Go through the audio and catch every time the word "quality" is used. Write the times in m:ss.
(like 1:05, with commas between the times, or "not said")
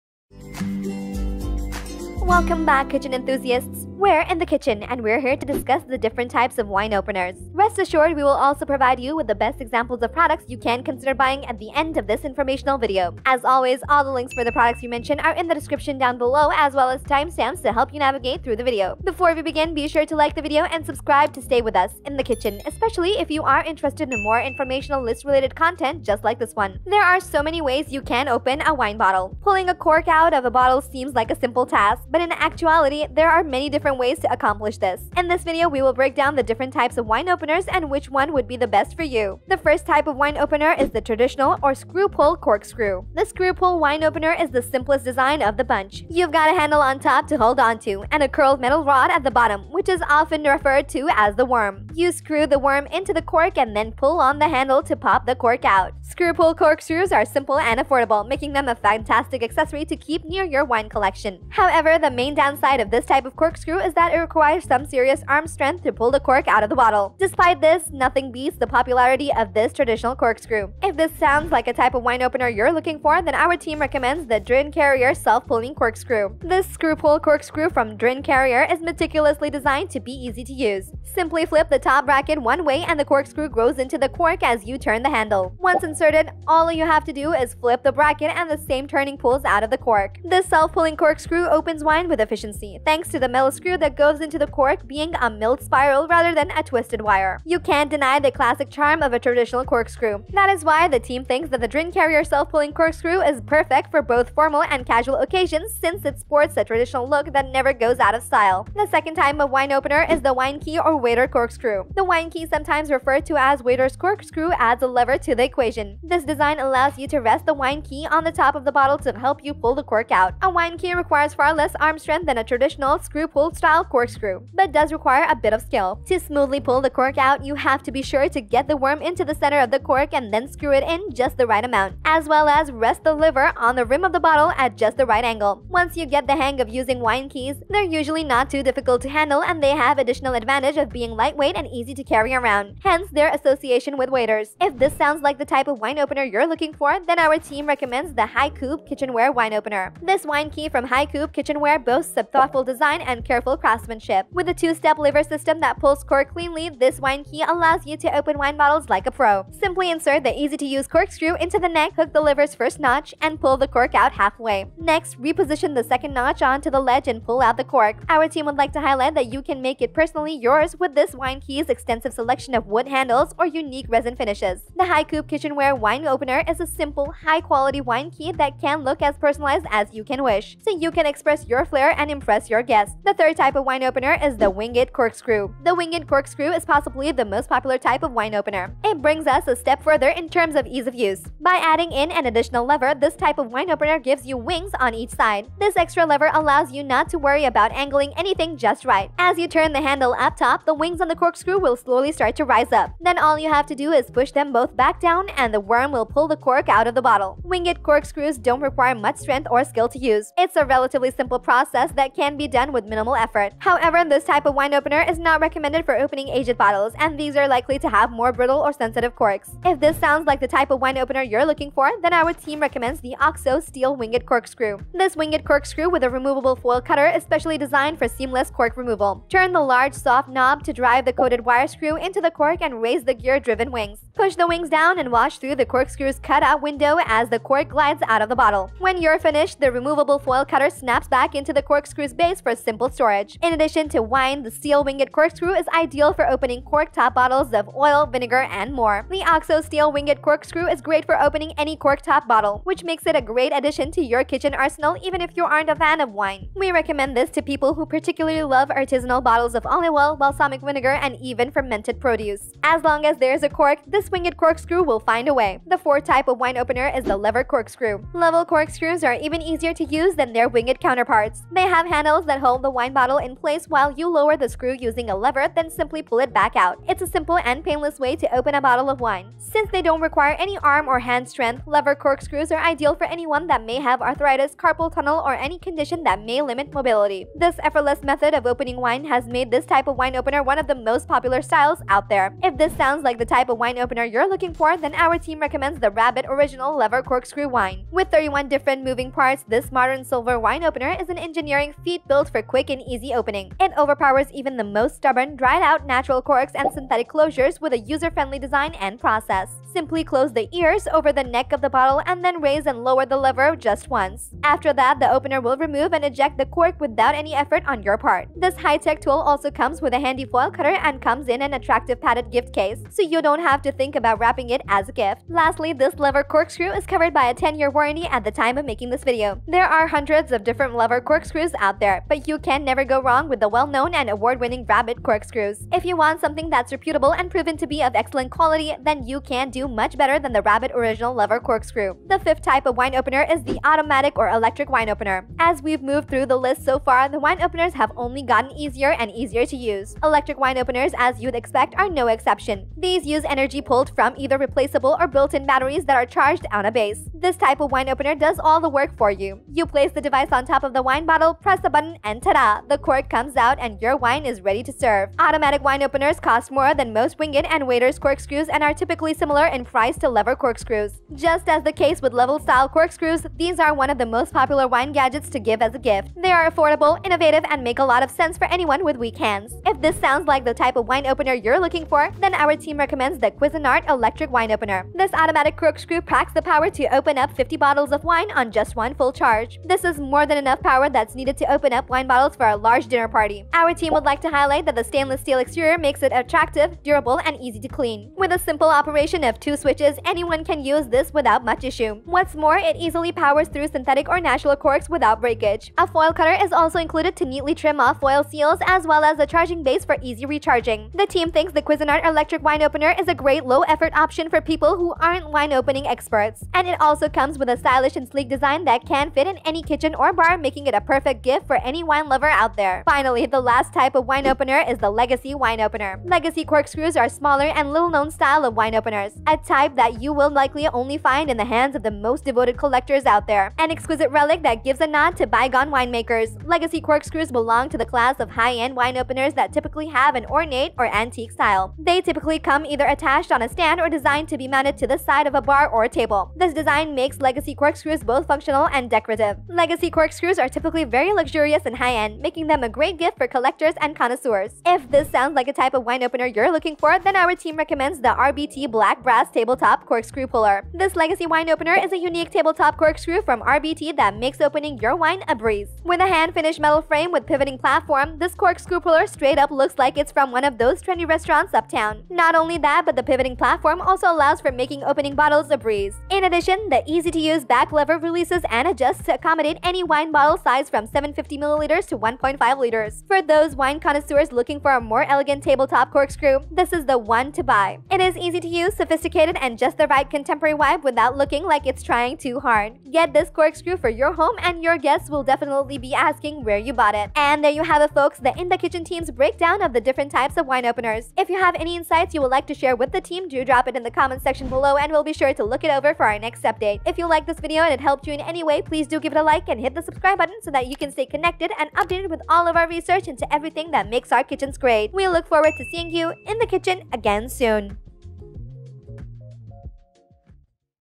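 2:57, 5:38.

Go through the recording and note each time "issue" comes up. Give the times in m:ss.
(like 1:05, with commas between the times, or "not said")
6:41.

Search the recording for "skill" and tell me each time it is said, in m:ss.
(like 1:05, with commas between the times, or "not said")
2:05, 3:29.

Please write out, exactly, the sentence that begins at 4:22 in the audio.
As long as there's a cork, this this winged corkscrew will find a way.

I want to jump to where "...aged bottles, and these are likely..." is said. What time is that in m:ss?
3:36.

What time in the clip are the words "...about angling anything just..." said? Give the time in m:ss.
3:17.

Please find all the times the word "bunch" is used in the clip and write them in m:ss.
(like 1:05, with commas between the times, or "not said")
0:45.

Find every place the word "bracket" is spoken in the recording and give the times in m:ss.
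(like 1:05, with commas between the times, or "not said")
1:22, 1:27.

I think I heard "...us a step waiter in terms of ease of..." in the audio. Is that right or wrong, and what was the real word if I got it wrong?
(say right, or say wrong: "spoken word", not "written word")
wrong: "further", not "waiter".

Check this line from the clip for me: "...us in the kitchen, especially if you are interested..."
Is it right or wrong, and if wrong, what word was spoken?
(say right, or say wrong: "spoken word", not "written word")
right.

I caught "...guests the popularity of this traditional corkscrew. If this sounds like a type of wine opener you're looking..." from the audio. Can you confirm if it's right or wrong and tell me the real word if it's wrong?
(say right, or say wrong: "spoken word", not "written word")
wrong: "beats", not "guests".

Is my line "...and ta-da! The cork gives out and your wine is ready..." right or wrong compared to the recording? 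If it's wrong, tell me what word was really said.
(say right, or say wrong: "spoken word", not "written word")
wrong: "comes", not "gives".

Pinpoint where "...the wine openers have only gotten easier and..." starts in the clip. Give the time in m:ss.
5:47.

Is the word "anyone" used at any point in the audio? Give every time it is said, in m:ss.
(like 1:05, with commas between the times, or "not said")
4:43, 6:18, 6:40.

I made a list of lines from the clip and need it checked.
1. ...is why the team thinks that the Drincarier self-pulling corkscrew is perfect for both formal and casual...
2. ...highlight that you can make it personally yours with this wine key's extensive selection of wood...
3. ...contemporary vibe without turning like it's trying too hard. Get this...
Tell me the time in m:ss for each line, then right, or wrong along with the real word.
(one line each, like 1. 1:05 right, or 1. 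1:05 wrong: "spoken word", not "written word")
1. 1:40 right
2. 2:48 right
3. 8:10 wrong: "looking", not "turning".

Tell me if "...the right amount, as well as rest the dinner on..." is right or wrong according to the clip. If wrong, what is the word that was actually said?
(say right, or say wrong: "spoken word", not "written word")
wrong: "liver", not "dinner".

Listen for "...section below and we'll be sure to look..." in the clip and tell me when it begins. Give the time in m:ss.
8:24.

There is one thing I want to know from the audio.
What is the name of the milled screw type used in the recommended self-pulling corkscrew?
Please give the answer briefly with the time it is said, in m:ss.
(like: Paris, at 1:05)
Millis screw, at 1:33.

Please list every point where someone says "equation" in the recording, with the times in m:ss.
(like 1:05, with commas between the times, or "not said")
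1:55.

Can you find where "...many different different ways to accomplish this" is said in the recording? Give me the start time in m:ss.
0:33.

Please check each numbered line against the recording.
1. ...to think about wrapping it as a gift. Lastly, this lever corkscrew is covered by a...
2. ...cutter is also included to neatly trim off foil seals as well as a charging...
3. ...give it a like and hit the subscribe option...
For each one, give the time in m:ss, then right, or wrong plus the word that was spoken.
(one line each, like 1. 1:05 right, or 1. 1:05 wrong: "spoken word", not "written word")
1. 5:23 right
2. 6:46 right
3. 8:28 wrong: "button", not "option".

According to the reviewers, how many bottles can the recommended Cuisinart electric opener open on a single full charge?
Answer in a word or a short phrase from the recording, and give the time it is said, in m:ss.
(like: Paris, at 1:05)
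50, at 6:27.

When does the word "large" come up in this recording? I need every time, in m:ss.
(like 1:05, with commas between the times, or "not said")
3:49, 6:32.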